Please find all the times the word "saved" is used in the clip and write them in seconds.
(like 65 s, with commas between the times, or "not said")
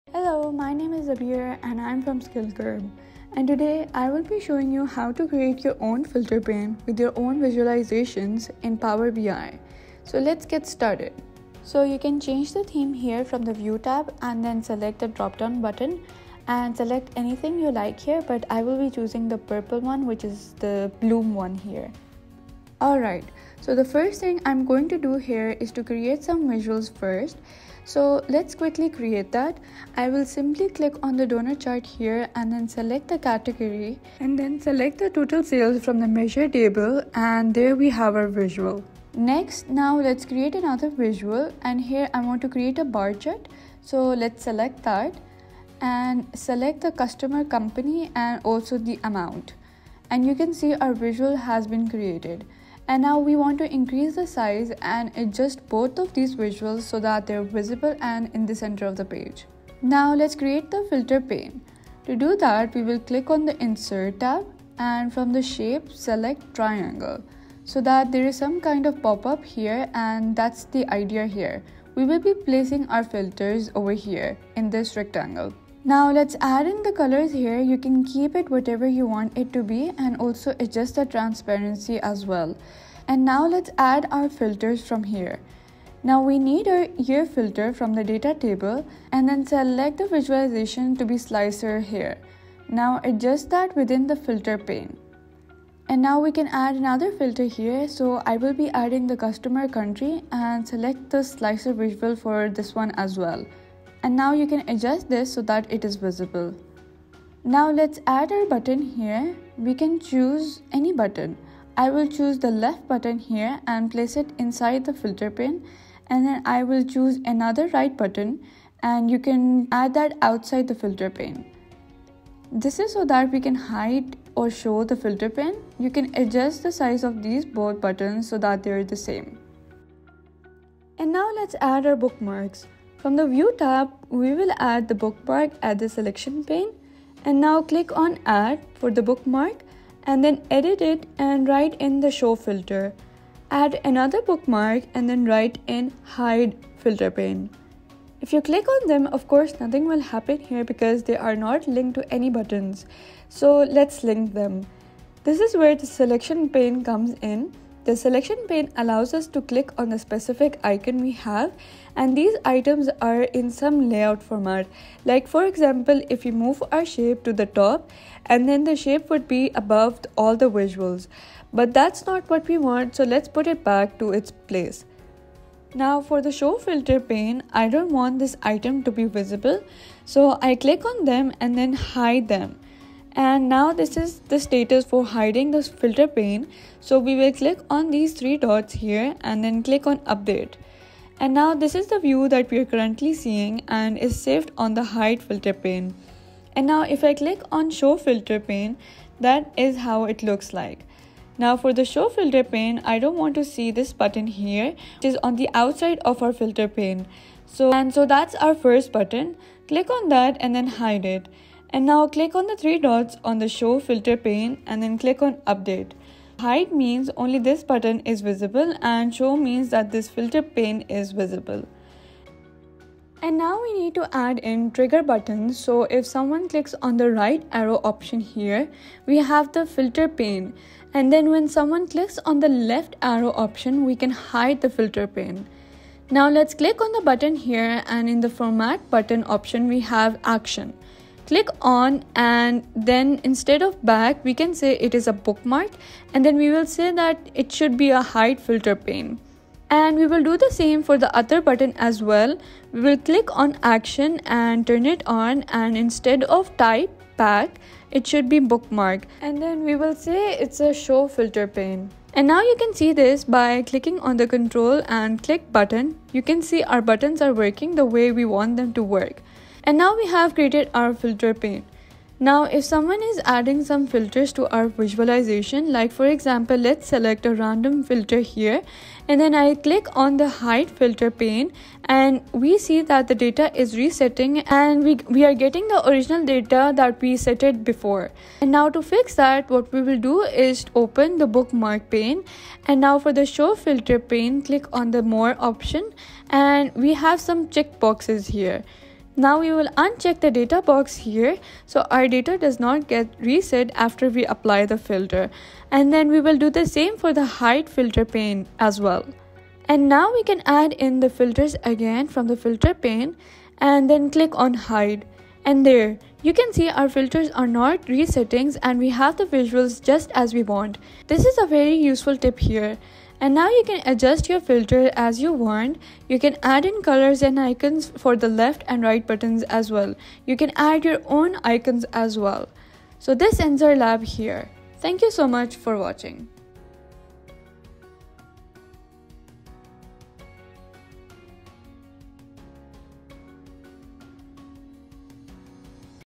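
194 s.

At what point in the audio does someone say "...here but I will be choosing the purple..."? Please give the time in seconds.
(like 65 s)
17 s.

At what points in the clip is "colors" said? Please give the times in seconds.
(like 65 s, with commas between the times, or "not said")
76 s, 326 s.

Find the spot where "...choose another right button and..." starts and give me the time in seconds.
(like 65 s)
116 s.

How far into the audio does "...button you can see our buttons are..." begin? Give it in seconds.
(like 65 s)
265 s.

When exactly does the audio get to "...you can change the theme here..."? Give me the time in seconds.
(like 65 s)
11 s.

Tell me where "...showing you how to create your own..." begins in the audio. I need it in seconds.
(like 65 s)
4 s.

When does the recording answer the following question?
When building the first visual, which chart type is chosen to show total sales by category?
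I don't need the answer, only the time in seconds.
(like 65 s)
31 s.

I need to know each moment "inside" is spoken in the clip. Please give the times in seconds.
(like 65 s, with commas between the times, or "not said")
114 s.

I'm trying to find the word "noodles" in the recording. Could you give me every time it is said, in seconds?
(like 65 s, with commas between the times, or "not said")
not said.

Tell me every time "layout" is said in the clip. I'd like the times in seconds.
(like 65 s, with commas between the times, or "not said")
163 s.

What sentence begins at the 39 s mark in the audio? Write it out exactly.
Next, now let's create another visual and here I want to create a bar chart.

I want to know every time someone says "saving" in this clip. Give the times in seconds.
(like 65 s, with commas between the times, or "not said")
not said.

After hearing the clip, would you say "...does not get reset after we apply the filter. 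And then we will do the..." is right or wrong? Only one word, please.
right.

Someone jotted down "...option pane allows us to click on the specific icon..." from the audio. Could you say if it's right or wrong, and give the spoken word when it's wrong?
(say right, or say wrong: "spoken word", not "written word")
wrong: "selection", not "option".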